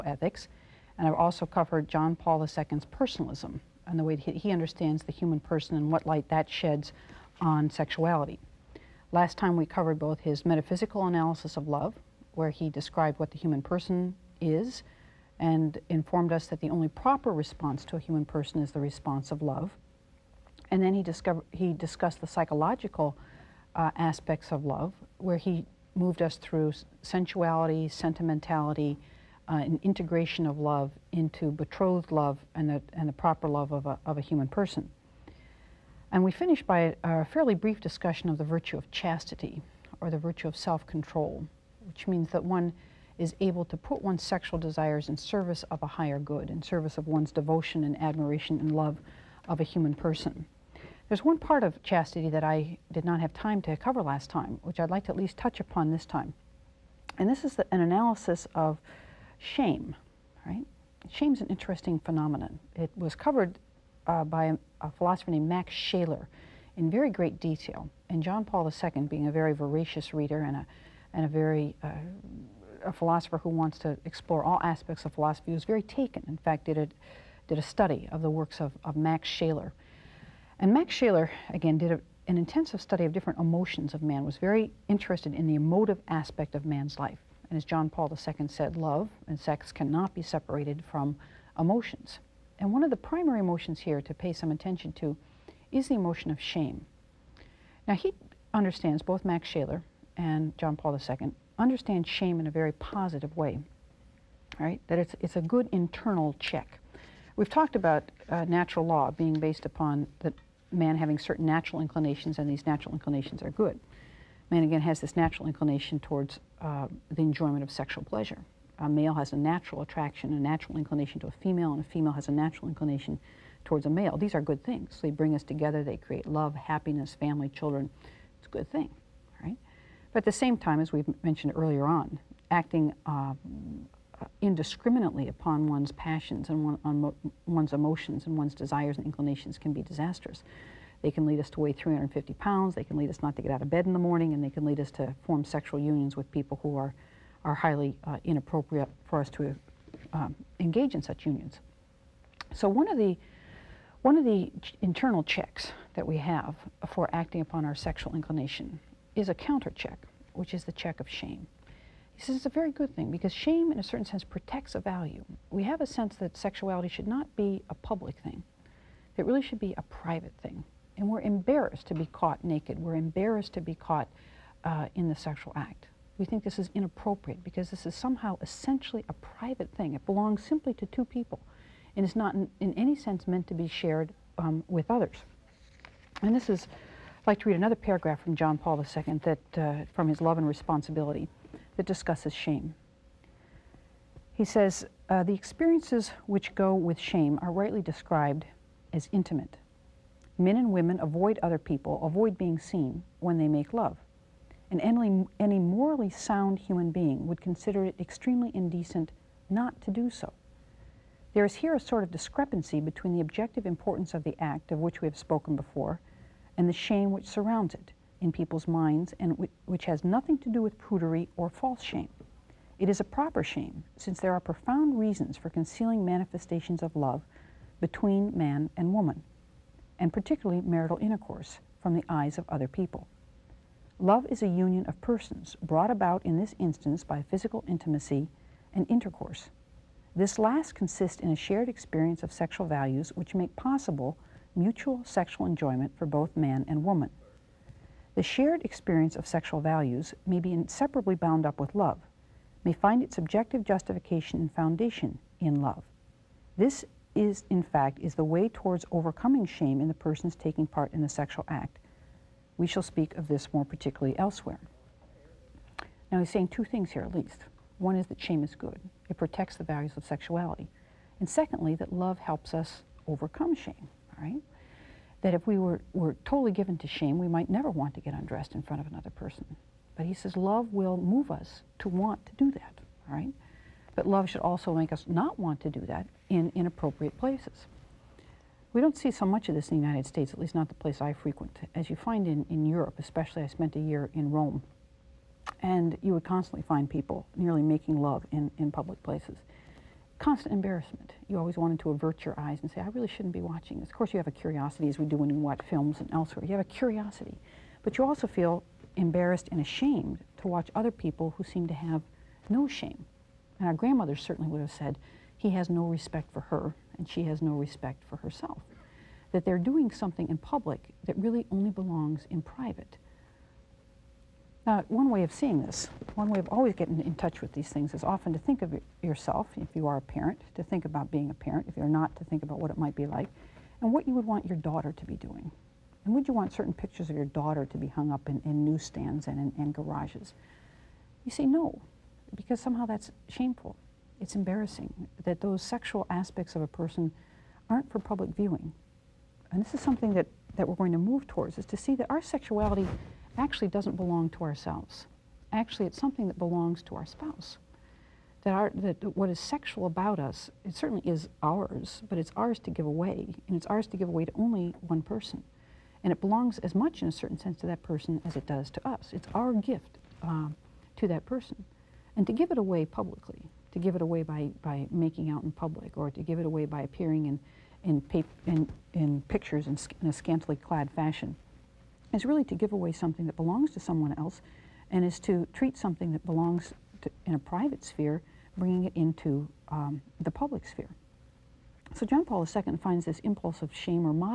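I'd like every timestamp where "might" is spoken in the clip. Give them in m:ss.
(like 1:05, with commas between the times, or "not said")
4:37, 5:32.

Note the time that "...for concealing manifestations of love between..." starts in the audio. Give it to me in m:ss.
3:45.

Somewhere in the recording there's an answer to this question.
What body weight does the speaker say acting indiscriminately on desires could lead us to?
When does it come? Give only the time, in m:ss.
2:21.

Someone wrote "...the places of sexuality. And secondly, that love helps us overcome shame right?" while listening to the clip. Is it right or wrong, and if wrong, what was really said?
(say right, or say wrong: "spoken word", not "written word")
wrong: "values", not "places".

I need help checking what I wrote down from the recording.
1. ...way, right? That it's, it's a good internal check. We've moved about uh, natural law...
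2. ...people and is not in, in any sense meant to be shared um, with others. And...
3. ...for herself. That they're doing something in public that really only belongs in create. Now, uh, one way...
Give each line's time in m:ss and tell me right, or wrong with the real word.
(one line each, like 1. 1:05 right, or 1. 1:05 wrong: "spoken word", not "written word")
1. 1:43 wrong: "talked", not "moved"
2. 3:01 right
3. 5:18 wrong: "private", not "create".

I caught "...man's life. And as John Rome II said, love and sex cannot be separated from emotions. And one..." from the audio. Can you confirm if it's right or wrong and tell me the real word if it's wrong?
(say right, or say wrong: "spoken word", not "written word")
wrong: "Paul", not "Rome".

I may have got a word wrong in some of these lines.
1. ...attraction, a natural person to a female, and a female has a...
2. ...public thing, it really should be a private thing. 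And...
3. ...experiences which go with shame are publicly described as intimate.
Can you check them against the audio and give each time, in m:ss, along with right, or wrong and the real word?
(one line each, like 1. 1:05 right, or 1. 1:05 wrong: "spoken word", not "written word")
1. 1:59 wrong: "inclination", not "person"
2. 2:47 right
3. 3:15 wrong: "rightly", not "publicly".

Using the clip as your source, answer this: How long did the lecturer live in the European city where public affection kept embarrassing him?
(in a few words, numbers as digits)
a year.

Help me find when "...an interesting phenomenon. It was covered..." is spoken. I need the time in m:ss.
1:01.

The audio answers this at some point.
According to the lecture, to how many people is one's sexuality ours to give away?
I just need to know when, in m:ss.
6:04.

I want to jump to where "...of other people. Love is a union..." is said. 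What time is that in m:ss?
3:52.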